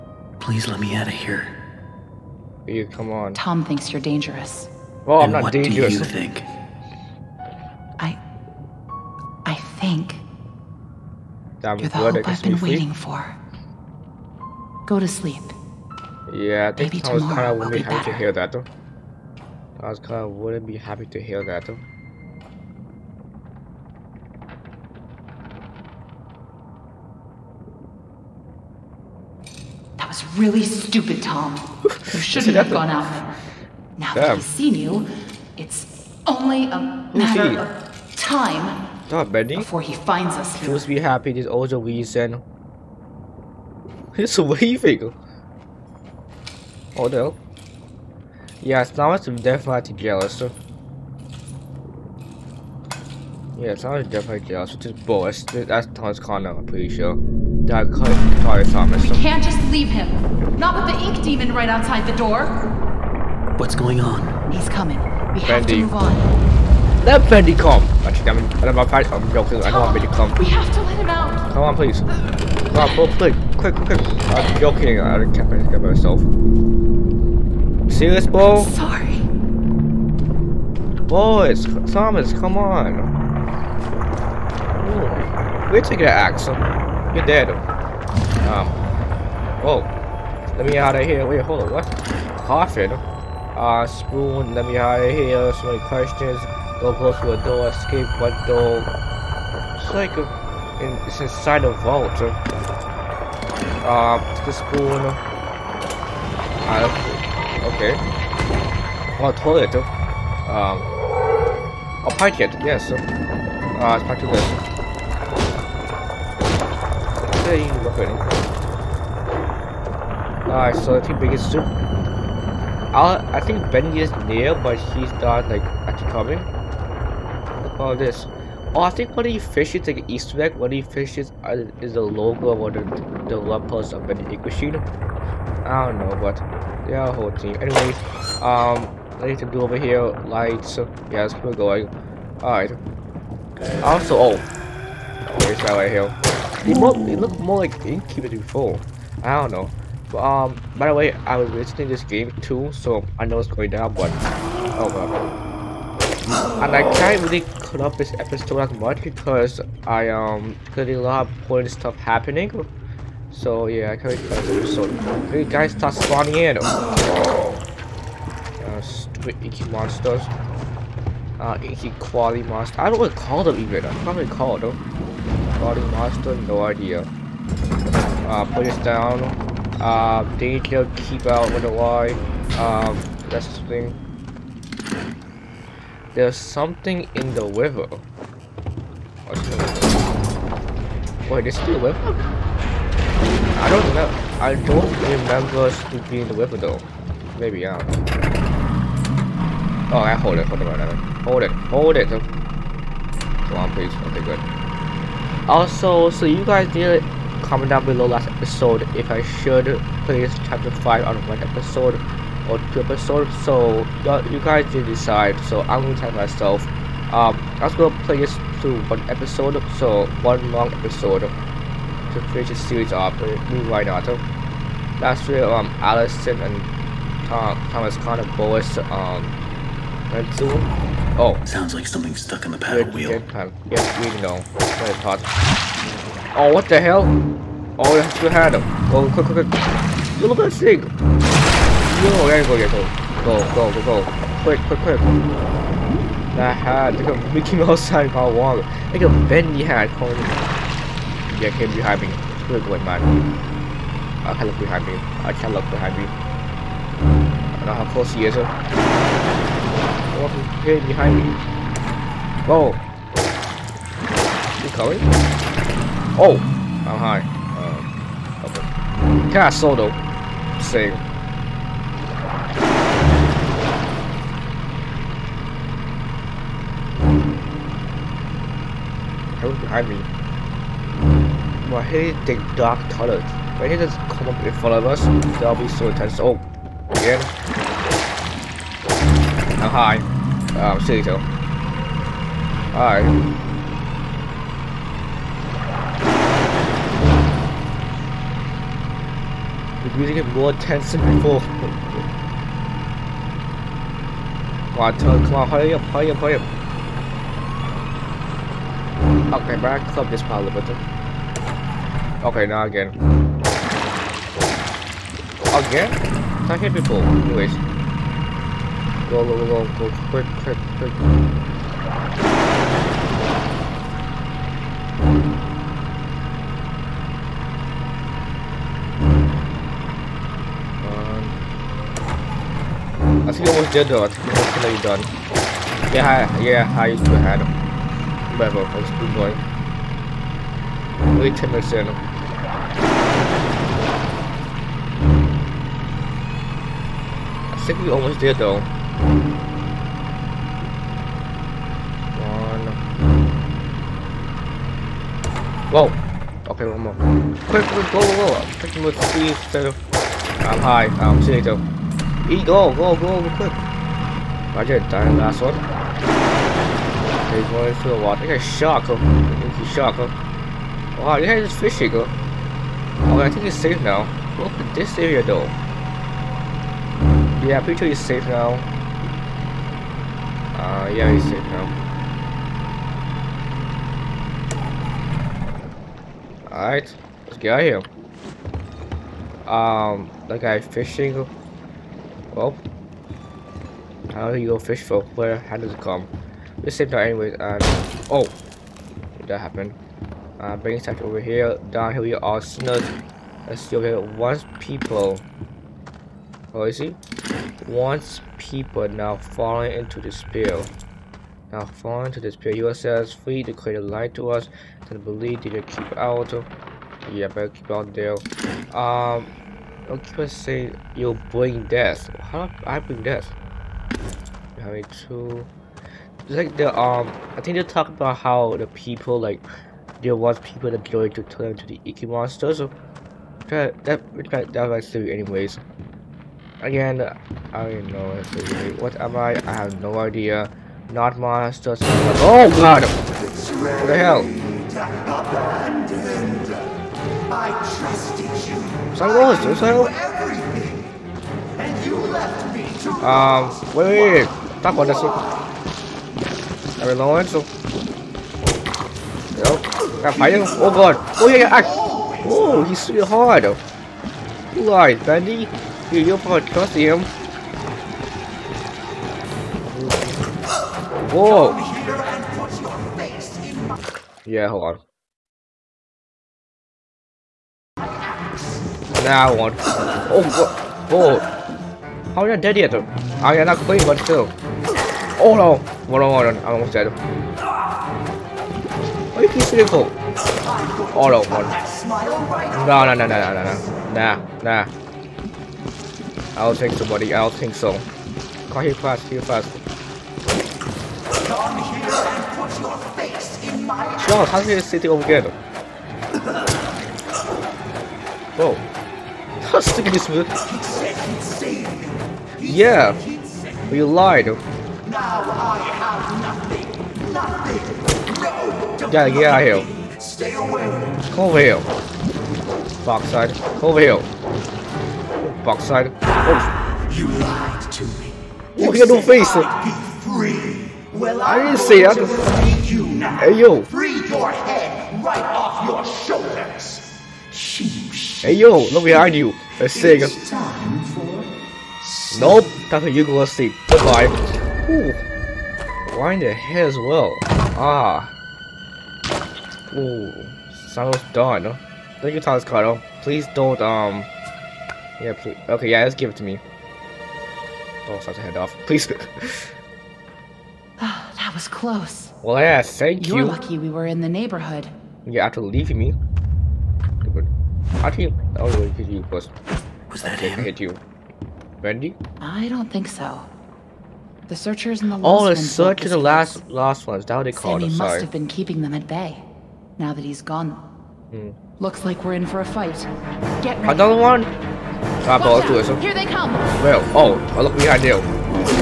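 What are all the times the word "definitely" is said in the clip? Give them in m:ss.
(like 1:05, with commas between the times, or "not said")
0:49, 0:54.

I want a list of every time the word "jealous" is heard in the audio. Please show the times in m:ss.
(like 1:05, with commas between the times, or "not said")
0:49, 0:54.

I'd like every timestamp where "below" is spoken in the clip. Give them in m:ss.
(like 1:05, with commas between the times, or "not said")
3:27.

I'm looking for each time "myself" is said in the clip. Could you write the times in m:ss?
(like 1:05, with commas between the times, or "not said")
1:15, 3:36.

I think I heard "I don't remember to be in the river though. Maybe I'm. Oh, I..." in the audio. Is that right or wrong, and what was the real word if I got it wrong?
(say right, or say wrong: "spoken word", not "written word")
right.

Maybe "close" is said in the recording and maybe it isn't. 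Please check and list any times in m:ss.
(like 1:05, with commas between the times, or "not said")
1:36, 4:17, 9:21.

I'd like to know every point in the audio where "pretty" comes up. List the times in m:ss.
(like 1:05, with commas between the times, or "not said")
0:56, 6:17.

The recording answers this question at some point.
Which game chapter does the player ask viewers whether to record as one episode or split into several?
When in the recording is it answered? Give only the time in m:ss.
3:30.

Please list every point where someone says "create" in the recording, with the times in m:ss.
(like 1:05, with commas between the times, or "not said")
6:53.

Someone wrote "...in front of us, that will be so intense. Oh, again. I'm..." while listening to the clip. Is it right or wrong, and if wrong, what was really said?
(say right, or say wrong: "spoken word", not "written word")
right.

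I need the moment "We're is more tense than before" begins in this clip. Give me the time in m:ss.
4:59.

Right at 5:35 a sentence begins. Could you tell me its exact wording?
Yeah, I, yeah, I used to have.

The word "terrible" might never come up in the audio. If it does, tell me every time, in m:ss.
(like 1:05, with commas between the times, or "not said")
not said.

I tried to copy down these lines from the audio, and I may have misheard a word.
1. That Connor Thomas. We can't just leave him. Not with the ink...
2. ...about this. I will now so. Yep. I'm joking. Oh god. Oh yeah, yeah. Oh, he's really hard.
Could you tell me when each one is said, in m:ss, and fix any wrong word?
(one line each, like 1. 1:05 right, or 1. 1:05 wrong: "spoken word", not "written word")
1. 0:57 right
2. 7:34 wrong: "fighting", not "joking".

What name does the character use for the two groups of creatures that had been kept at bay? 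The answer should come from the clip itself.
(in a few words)
The searchers and the lost.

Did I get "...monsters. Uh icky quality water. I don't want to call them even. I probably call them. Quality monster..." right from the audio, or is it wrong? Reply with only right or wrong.
wrong.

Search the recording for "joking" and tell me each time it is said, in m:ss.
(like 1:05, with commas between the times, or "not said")
1:09, 1:14.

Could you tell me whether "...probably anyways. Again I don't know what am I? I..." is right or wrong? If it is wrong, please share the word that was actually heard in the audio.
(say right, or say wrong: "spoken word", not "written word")
wrong: "silly", not "probably".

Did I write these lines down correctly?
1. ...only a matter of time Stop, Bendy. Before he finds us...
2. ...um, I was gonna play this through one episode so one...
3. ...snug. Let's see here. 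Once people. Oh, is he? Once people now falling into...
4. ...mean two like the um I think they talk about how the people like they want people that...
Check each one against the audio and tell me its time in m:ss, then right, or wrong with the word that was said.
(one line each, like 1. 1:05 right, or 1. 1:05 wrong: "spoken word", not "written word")
1. 0:36 right
2. 3:37 right
3. 6:42 right
4. 7:04 right.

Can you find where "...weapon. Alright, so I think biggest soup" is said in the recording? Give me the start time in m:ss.
1:57.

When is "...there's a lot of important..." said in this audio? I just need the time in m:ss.
2:40.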